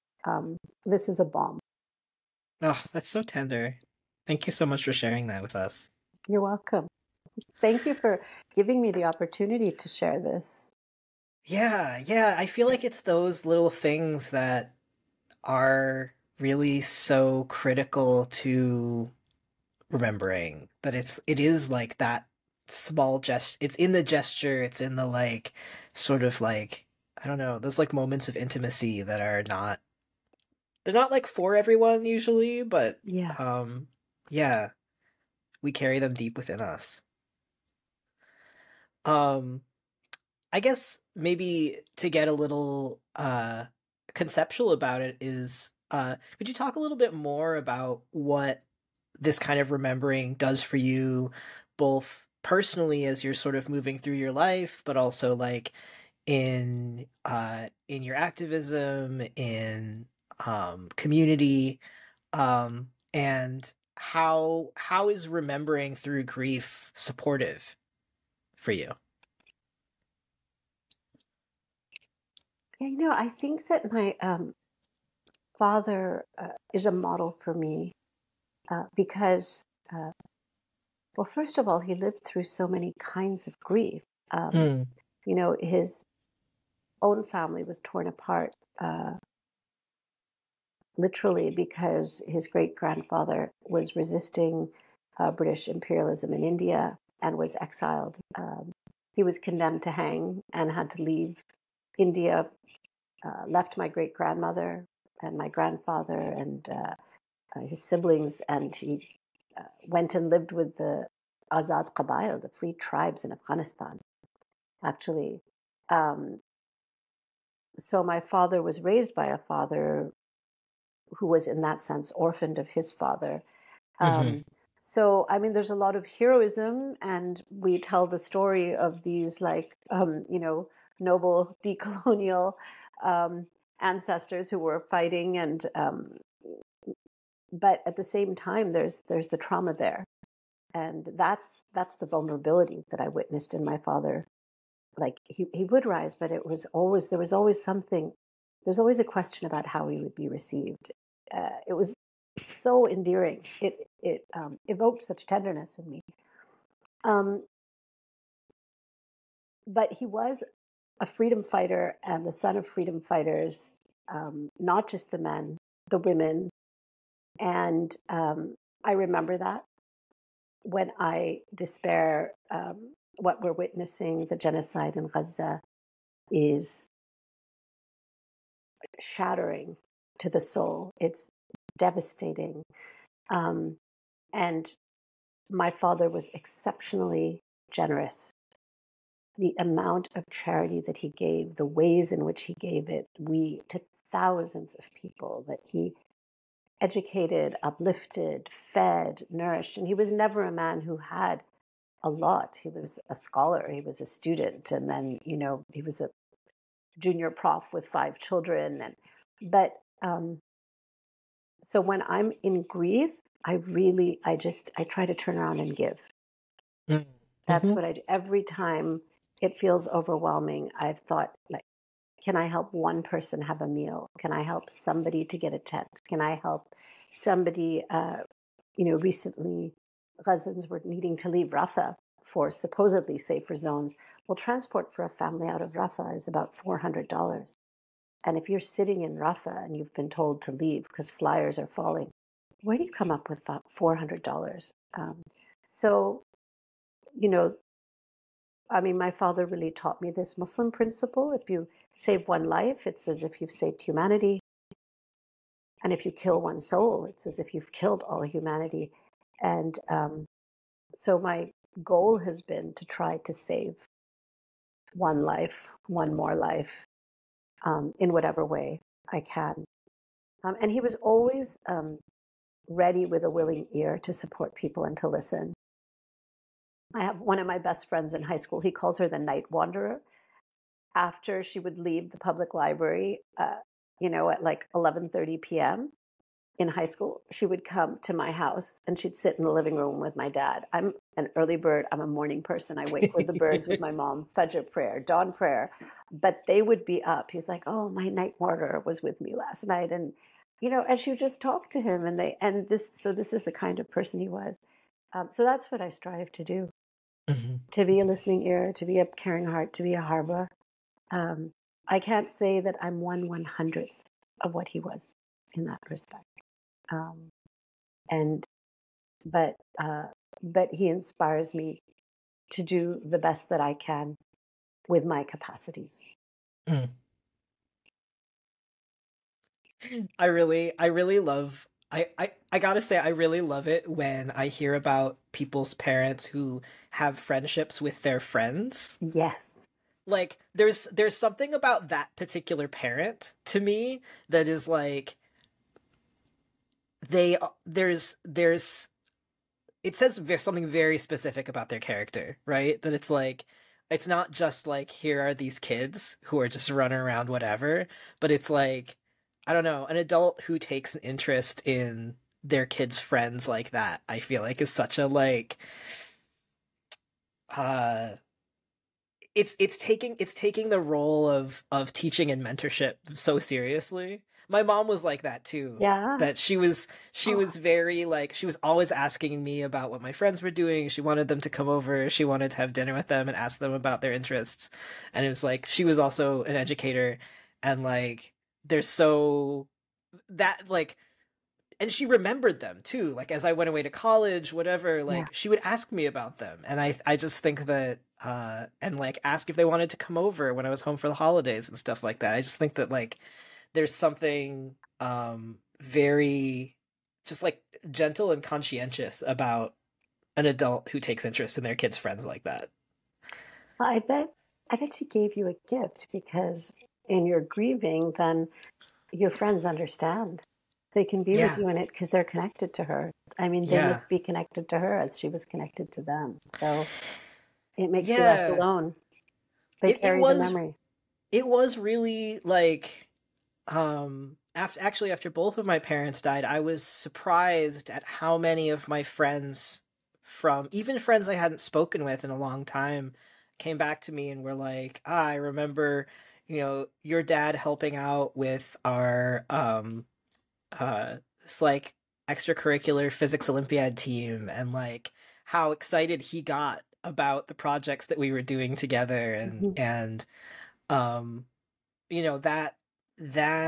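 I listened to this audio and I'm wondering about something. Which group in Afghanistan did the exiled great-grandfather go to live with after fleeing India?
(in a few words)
Azad Qabail.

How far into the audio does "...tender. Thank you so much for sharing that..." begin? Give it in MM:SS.
00:03.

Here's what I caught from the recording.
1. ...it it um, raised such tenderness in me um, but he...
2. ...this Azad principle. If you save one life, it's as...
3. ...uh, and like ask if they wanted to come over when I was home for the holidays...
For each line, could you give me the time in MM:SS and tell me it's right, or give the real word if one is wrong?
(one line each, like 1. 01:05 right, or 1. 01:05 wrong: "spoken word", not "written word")
1. 02:33 wrong: "evoked", not "raised"
2. 04:10 wrong: "Muslim", not "Azad"
3. 06:38 right.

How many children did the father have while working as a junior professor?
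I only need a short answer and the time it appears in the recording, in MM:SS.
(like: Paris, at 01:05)
5, at 03:27.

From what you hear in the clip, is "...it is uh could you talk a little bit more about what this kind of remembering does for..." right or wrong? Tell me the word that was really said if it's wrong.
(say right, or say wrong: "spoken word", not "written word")
right.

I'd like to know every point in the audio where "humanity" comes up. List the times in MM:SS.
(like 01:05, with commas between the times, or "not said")
04:13, 04:18.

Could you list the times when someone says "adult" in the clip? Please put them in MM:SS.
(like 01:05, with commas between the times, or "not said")
05:59, 06:50.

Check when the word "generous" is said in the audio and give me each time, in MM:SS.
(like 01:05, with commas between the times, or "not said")
03:07.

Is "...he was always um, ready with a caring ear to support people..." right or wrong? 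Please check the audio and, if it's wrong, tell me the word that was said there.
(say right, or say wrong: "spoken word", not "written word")
wrong: "willing", not "caring".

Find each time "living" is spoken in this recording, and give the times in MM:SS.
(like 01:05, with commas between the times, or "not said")
04:49.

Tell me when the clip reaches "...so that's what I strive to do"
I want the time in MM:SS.
05:05.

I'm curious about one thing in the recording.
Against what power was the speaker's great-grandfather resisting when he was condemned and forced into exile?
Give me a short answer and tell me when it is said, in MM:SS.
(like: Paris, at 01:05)
British imperialism, at 01:35.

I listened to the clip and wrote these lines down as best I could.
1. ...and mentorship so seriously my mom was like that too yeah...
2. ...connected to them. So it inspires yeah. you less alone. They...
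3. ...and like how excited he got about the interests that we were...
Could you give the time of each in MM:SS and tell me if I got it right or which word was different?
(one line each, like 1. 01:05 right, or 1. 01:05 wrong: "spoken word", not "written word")
1. 06:12 right
2. 07:05 wrong: "makes", not "inspires"
3. 07:34 wrong: "projects", not "interests".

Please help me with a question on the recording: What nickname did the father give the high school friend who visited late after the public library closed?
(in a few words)
the night wanderer.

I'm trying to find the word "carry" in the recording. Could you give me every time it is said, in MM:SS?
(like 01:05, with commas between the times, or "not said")
00:35, 07:10.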